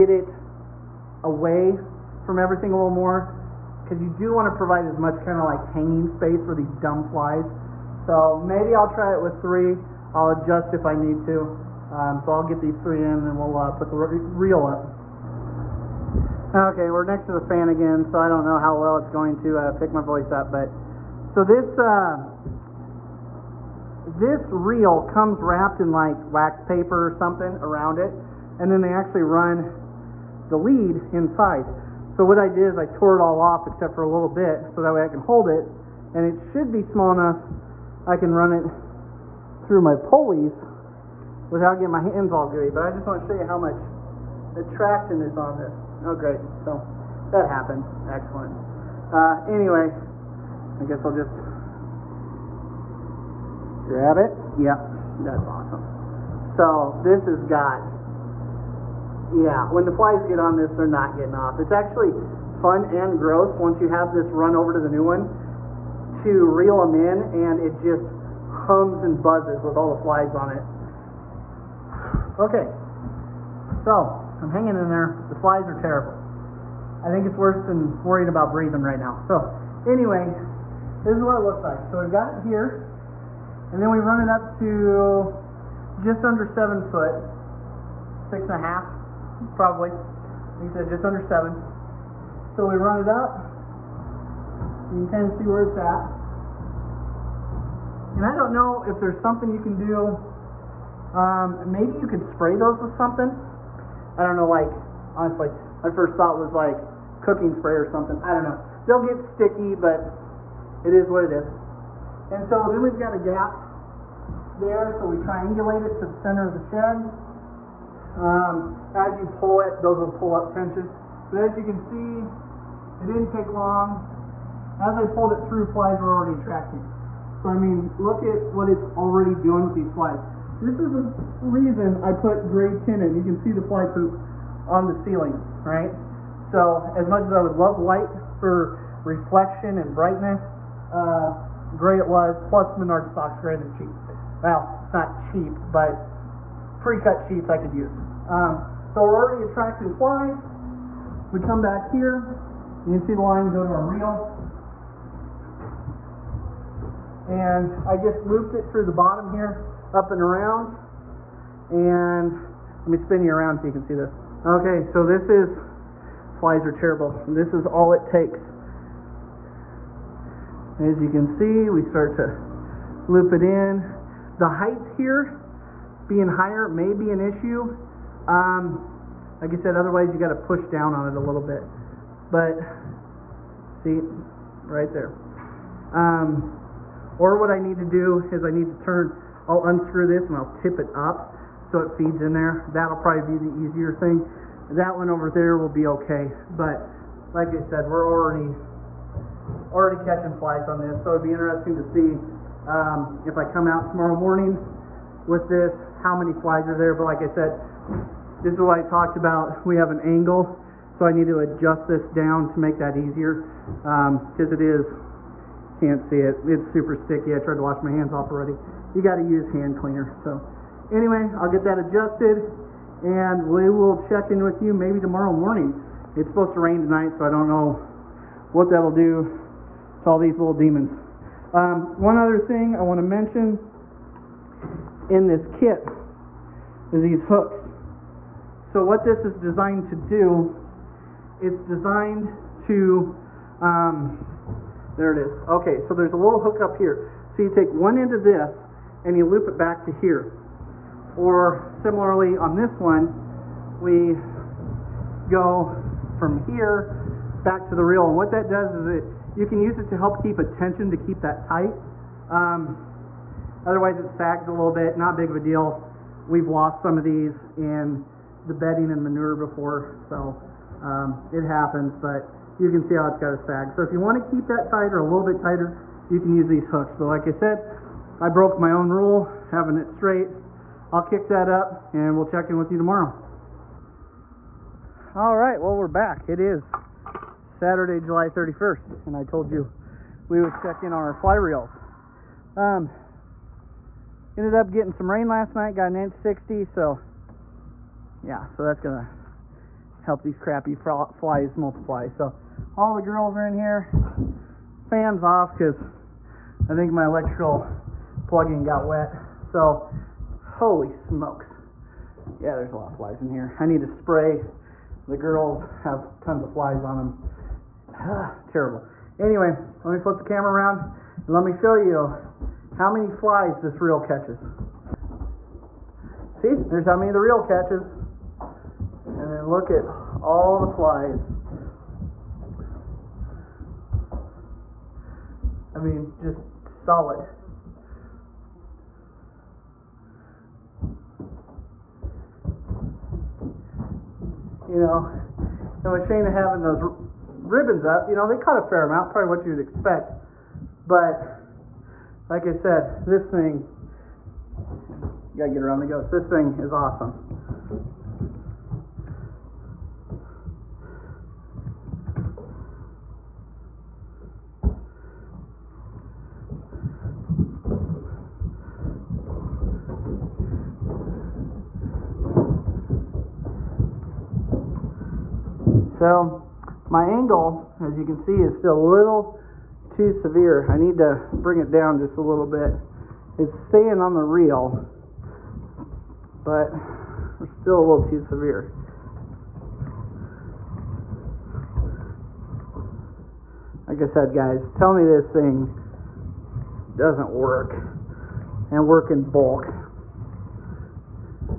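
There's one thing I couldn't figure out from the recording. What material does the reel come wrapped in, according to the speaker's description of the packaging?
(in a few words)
wax paper.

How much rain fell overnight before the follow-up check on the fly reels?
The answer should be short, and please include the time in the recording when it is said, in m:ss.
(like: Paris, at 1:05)
1.60 inches, at 4:55.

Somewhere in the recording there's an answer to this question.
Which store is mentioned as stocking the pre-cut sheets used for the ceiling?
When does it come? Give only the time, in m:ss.
2:22.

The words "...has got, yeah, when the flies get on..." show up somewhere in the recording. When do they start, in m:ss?
0:57.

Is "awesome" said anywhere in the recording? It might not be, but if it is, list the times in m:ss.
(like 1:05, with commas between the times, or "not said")
0:55, 5:56.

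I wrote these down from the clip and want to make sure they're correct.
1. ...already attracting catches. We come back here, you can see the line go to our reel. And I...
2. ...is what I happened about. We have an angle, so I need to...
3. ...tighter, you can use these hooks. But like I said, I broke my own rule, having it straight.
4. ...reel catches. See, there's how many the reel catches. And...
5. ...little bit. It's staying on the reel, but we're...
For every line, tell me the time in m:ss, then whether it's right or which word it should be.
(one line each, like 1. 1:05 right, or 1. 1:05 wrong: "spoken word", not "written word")
1. 2:29 wrong: "flies", not "catches"
2. 3:28 wrong: "talked", not "happened"
3. 4:35 right
4. 5:23 right
5. 6:22 right.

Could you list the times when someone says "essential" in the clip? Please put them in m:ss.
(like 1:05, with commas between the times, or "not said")
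not said.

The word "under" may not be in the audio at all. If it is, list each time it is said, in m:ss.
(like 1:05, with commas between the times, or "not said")
1:26, 1:31.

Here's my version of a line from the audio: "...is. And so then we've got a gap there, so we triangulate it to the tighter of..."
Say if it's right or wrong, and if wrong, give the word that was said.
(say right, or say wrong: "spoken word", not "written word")
wrong: "center", not "tighter".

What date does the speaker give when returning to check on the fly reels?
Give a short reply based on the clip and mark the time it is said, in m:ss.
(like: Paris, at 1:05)
Saturday, July 31st, at 4:47.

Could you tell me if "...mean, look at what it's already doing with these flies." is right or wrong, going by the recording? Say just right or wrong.
right.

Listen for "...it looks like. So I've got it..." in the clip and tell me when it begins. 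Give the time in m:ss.
1:21.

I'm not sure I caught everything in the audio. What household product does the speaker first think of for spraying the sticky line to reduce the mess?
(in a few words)
cooking spray.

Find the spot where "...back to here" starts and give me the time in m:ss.
4:09.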